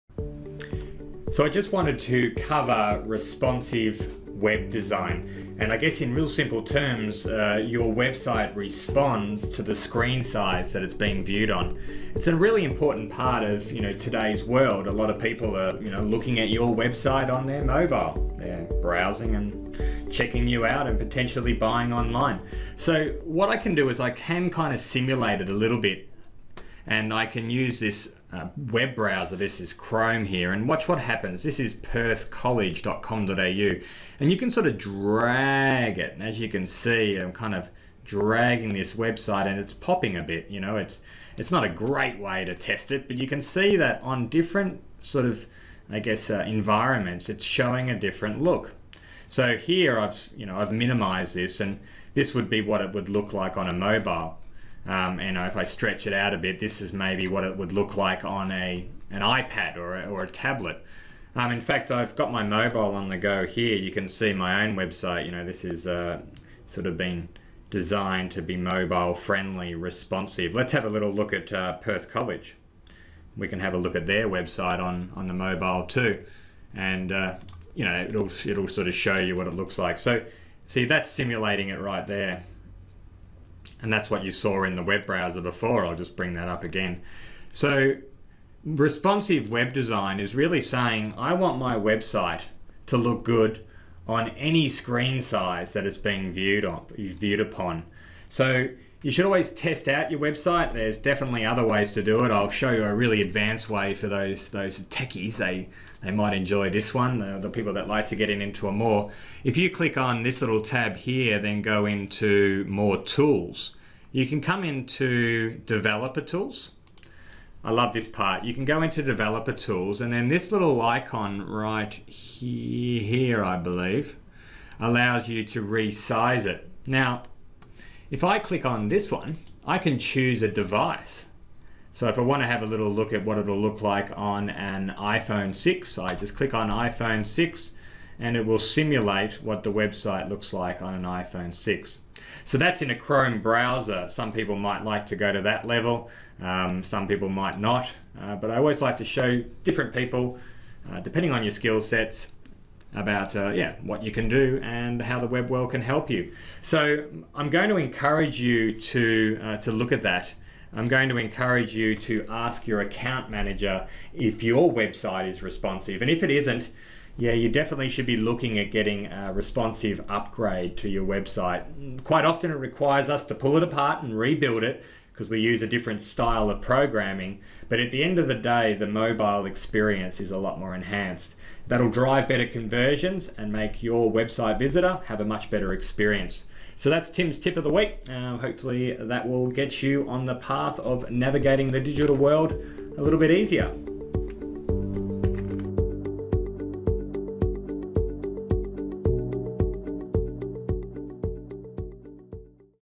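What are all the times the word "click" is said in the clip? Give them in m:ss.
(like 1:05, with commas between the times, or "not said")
1:49, 2:08, 2:16.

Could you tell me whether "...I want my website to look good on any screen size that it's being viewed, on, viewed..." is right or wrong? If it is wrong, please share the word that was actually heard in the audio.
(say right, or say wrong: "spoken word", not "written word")
right.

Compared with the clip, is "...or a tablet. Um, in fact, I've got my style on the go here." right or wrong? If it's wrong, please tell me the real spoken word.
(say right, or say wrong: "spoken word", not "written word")
wrong: "mobile", not "style".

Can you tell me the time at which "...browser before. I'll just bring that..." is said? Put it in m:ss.
1:25.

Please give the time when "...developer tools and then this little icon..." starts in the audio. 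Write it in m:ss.
1:59.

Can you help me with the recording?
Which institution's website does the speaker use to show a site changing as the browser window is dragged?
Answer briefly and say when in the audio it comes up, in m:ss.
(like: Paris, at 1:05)
Perth College, at 0:31.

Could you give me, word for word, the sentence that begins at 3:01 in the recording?
That'll drive better conversions and make your website visitor have a much better experience.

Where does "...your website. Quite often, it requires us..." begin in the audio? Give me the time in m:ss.
2:50.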